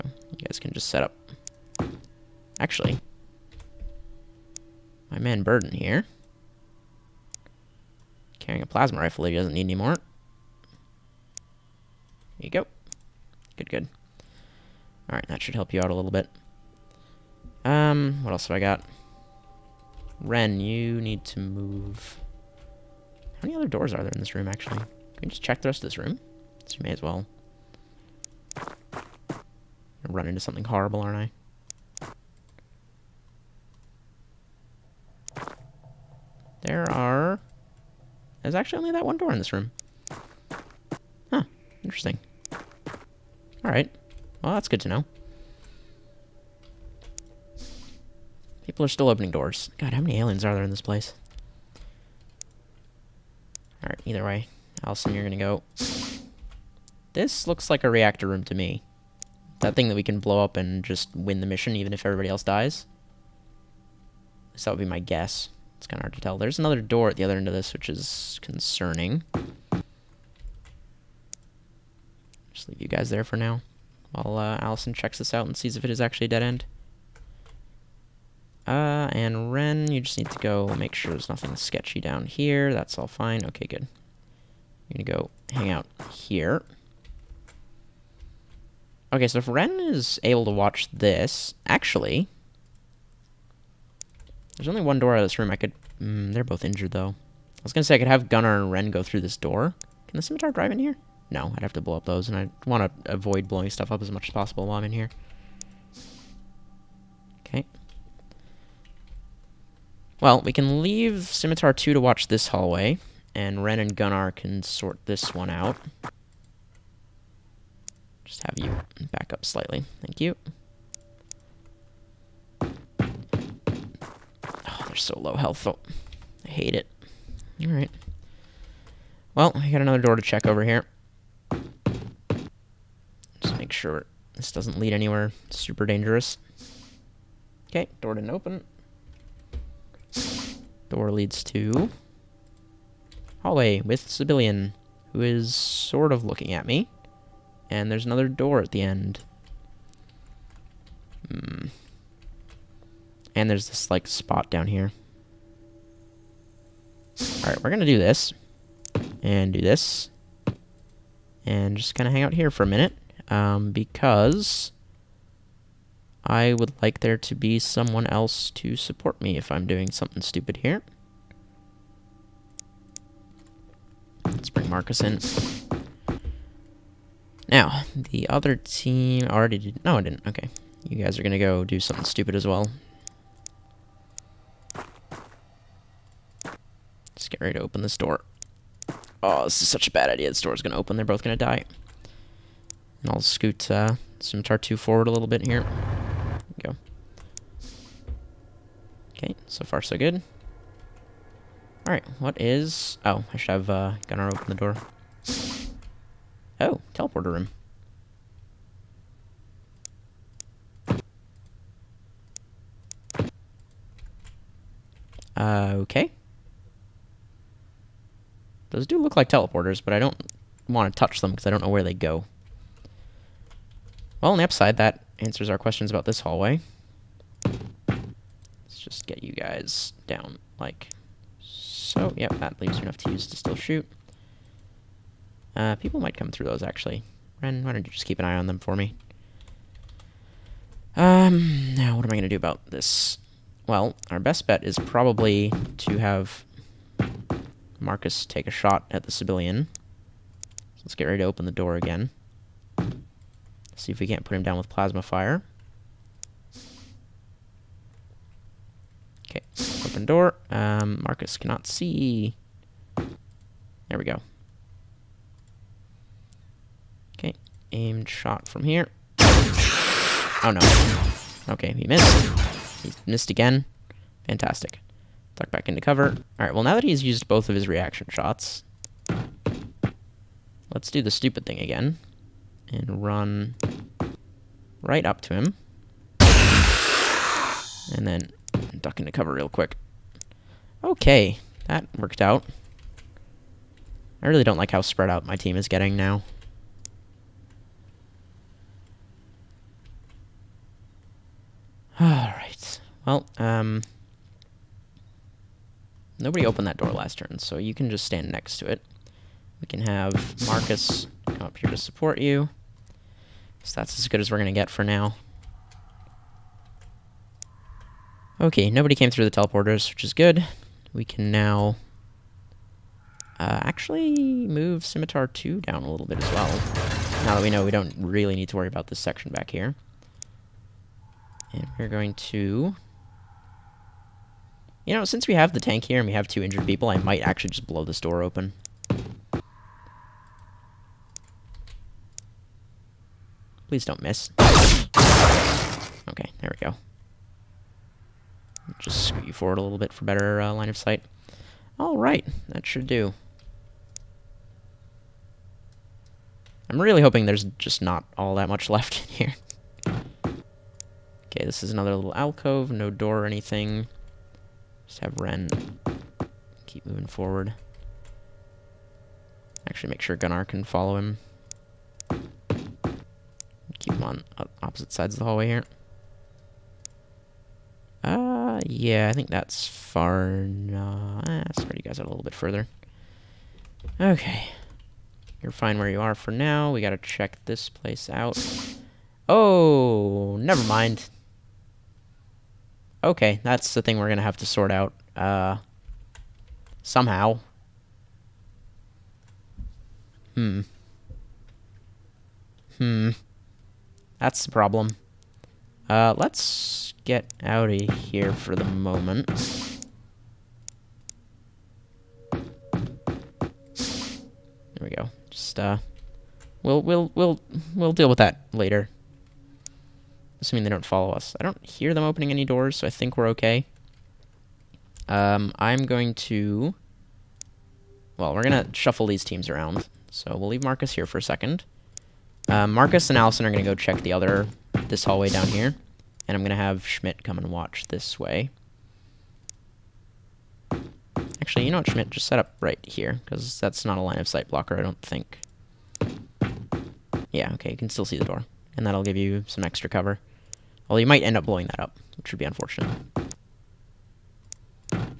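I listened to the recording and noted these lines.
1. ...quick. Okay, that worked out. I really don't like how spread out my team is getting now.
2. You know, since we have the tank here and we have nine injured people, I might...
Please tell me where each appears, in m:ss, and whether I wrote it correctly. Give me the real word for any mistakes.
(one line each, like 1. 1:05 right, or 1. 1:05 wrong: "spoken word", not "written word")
1. 4:49 right
2. 5:34 wrong: "two", not "nine".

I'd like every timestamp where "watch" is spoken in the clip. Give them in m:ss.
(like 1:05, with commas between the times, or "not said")
1:30, 1:52, 7:17.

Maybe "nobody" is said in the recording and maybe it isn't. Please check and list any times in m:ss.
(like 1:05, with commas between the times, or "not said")
5:06, 5:18.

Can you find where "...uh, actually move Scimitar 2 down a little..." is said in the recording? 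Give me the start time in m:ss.
5:23.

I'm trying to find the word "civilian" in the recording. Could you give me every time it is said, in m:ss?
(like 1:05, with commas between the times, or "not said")
2:24, 4:09.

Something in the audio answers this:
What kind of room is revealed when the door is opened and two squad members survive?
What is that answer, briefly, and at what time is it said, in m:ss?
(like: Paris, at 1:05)
Teleporter room, at 3:26.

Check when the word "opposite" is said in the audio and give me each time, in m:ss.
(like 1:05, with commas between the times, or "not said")
6:14.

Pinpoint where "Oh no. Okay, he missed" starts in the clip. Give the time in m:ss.
4:29.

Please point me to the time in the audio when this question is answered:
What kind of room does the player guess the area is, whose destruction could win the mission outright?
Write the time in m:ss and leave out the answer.
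0:57.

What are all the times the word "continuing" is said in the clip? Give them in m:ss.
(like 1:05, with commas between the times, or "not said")
not said.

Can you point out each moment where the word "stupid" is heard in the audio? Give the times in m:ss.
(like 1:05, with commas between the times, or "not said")
2:50, 3:02, 4:41.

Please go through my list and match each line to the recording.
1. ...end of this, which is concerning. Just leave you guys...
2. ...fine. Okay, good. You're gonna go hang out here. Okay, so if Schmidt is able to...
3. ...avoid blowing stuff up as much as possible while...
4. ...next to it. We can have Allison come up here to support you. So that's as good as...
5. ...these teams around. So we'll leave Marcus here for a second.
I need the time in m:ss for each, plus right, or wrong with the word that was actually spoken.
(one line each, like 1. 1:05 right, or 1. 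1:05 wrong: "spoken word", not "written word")
1. 1:07 right
2. 1:23 wrong: "Ren", not "Schmidt"
3. 1:43 right
4. 5:08 wrong: "Marcus", not "Allison"
5. 7:09 right.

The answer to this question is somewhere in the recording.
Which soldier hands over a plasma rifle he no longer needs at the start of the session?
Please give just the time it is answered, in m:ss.
0:05.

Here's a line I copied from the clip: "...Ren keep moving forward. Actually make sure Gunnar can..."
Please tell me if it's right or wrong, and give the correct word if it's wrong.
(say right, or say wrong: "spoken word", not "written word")
right.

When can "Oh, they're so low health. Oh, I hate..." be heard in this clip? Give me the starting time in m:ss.
2:02.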